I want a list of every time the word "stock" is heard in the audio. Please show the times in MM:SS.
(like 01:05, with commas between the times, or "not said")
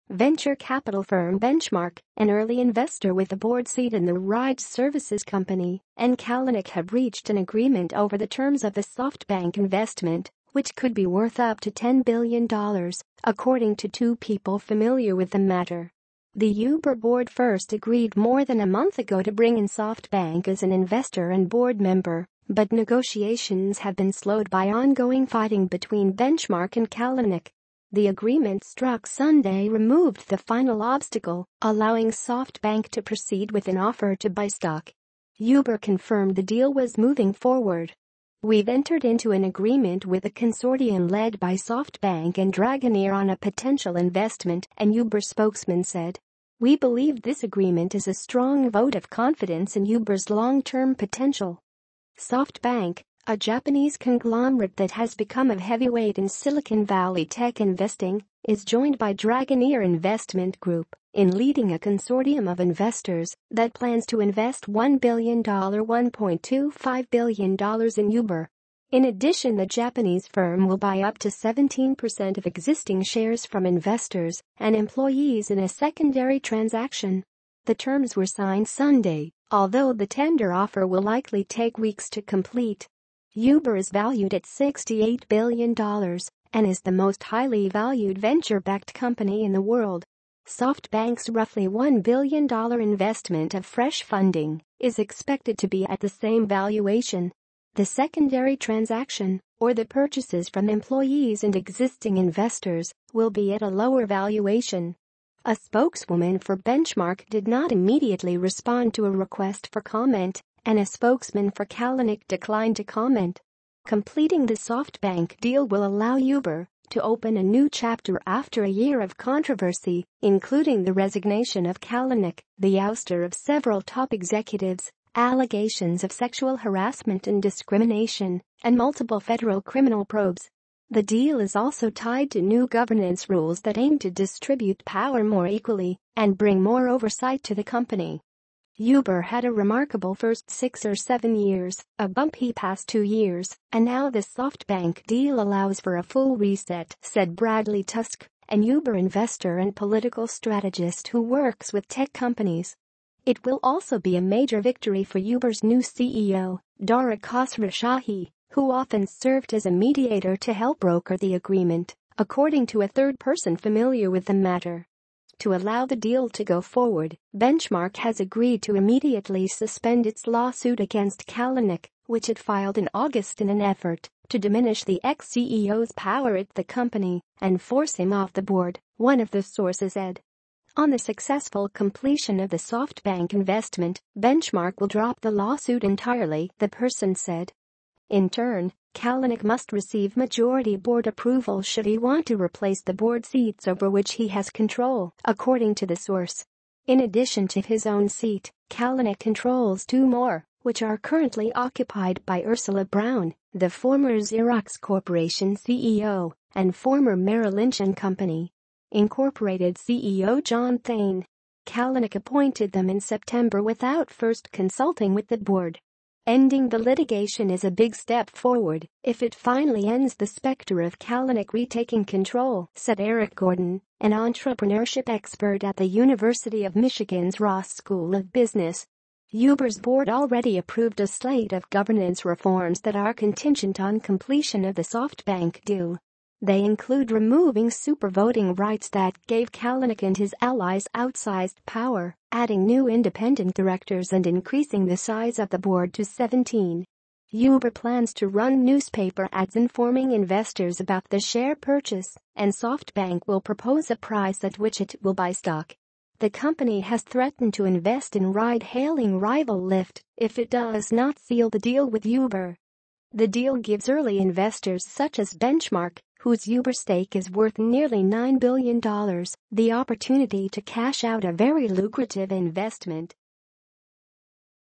00:34, 04:15.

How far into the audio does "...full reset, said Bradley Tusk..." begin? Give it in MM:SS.
02:26.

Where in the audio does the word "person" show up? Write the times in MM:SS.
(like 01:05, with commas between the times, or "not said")
02:43, 03:06.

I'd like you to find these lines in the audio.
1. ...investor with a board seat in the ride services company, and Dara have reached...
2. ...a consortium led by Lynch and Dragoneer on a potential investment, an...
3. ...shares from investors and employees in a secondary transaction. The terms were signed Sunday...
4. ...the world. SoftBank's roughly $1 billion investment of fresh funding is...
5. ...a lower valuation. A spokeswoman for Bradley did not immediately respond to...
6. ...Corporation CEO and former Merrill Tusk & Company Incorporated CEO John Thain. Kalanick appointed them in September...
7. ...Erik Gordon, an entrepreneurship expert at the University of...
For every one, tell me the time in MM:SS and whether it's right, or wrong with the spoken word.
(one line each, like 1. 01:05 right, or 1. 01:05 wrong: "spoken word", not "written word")
1. 00:02 wrong: "Kalanick", not "Dara"
2. 00:40 wrong: "SoftBank", not "Lynch"
3. 01:13 right
4. 01:29 right
5. 01:43 wrong: "Benchmark", not "Bradley"
6. 03:24 wrong: "Lynch", not "Tusk"
7. 03:42 right.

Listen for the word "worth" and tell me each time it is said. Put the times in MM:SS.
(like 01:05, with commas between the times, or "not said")
00:11, 04:27.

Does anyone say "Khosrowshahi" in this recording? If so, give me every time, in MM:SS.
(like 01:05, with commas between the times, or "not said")
02:37.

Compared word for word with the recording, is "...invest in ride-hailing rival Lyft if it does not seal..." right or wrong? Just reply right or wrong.
right.